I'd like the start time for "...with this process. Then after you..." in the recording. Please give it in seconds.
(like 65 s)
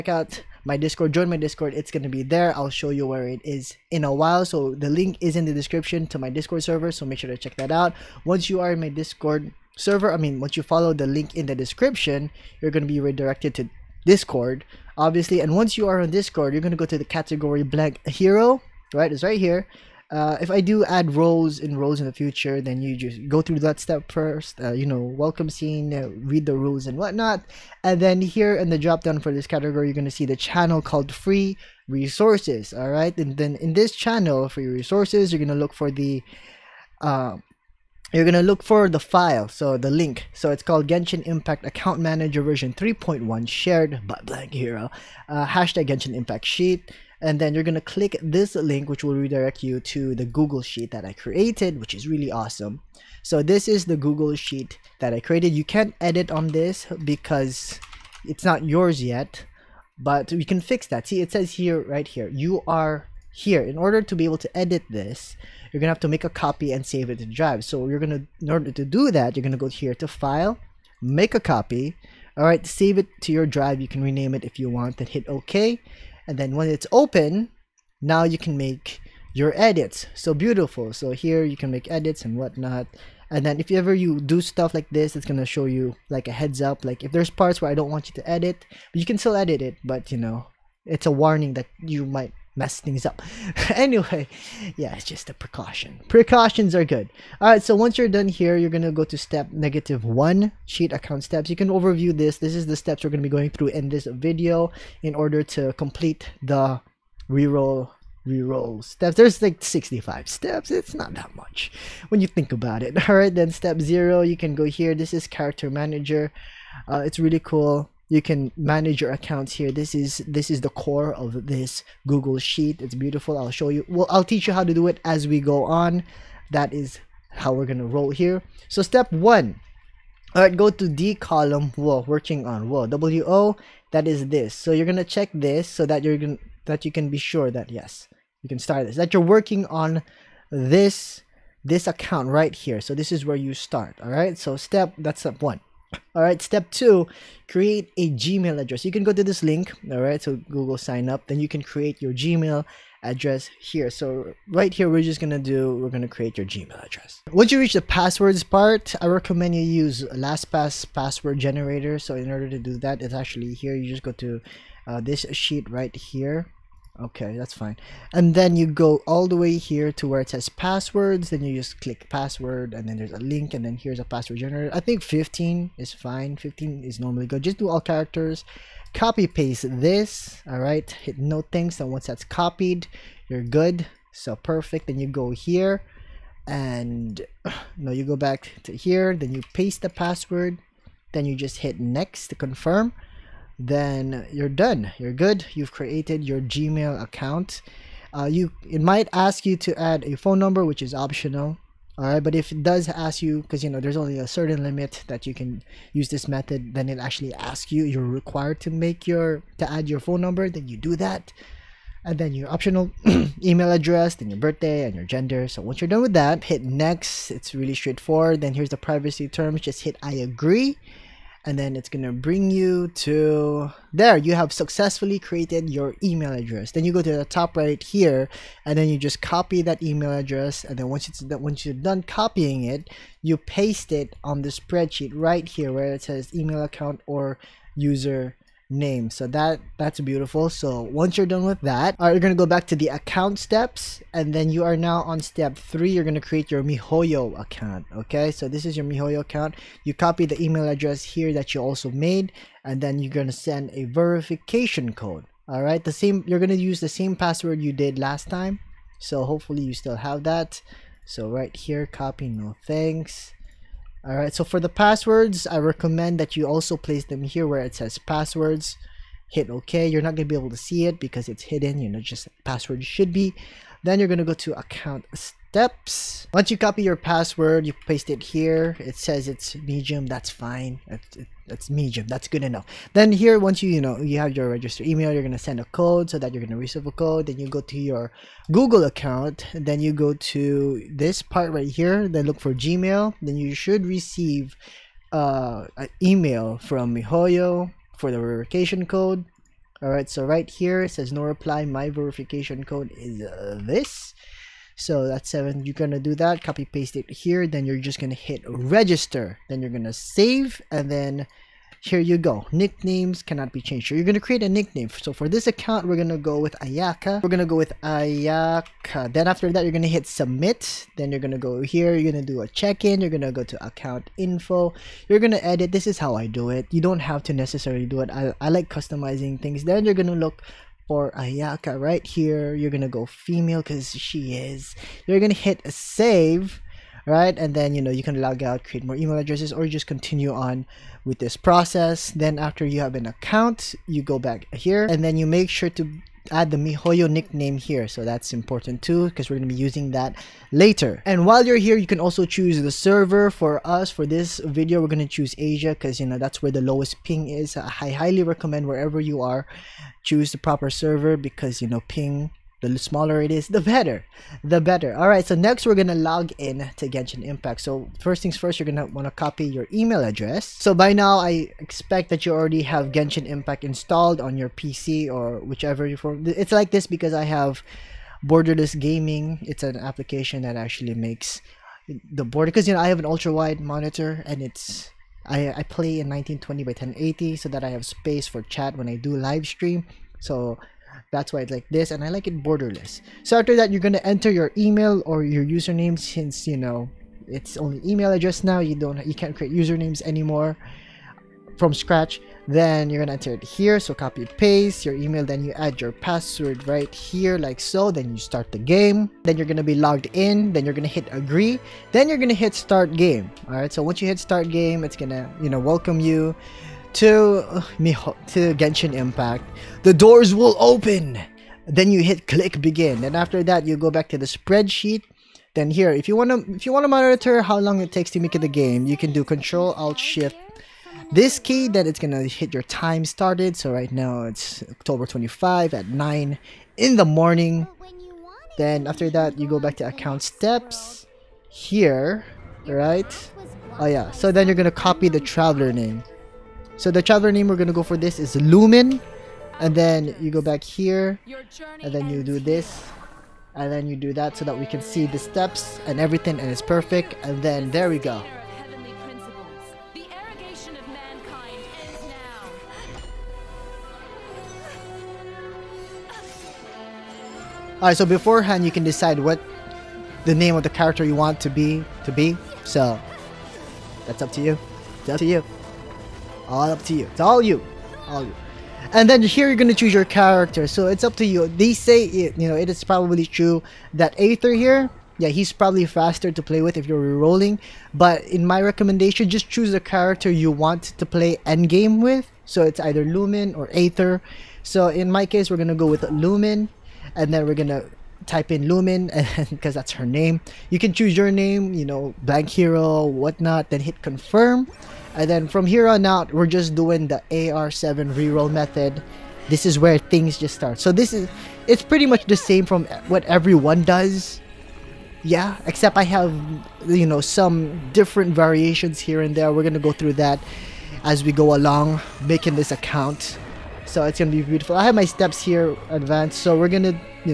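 341 s.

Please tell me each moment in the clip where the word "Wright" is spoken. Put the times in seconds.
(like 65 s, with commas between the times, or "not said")
not said.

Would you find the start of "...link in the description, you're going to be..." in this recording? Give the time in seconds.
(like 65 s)
11 s.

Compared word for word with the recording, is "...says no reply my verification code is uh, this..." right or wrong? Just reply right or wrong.
right.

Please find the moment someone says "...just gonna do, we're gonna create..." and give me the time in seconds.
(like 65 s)
155 s.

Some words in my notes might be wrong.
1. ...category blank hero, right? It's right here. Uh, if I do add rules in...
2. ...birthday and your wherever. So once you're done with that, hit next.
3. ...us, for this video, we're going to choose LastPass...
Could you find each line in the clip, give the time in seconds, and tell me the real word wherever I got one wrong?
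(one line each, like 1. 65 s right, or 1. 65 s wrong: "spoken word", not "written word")
1. 17 s wrong: "roles", not "rules"
2. 214 s wrong: "gender", not "wherever"
3. 353 s wrong: "Asia", not "LastPass".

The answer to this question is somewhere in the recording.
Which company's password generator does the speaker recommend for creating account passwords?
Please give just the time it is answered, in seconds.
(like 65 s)
160 s.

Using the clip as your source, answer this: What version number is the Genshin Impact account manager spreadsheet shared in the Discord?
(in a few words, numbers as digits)
3.1.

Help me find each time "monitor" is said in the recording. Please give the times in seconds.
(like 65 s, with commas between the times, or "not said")
383 s, 426 s.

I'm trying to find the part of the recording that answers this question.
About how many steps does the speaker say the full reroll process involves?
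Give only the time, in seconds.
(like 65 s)
109 s.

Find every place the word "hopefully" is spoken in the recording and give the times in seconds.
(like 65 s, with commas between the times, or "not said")
259 s.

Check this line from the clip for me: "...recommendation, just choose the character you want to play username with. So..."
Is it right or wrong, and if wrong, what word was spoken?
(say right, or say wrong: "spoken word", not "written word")
wrong: "endgame", not "username".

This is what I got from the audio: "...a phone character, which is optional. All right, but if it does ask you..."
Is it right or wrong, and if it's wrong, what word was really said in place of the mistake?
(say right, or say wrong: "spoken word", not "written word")
wrong: "number", not "character".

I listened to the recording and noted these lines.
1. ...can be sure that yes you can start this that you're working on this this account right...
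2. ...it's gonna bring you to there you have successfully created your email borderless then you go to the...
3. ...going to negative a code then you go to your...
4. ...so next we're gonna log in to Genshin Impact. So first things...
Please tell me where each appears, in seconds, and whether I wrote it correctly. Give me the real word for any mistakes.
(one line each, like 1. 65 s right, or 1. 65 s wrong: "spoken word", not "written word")
1. 136 s right
2. 221 s wrong: "address", not "borderless"
3. 286 s wrong: "receive", not "negative"
4. 365 s right.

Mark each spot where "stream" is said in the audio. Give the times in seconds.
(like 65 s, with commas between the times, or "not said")
389 s.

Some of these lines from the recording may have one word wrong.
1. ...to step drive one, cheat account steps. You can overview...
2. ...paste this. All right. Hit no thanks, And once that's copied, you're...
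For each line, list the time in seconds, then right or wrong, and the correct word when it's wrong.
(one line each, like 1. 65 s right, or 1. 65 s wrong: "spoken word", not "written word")
1. 99 s wrong: "negative", not "drive"
2. 179 s right.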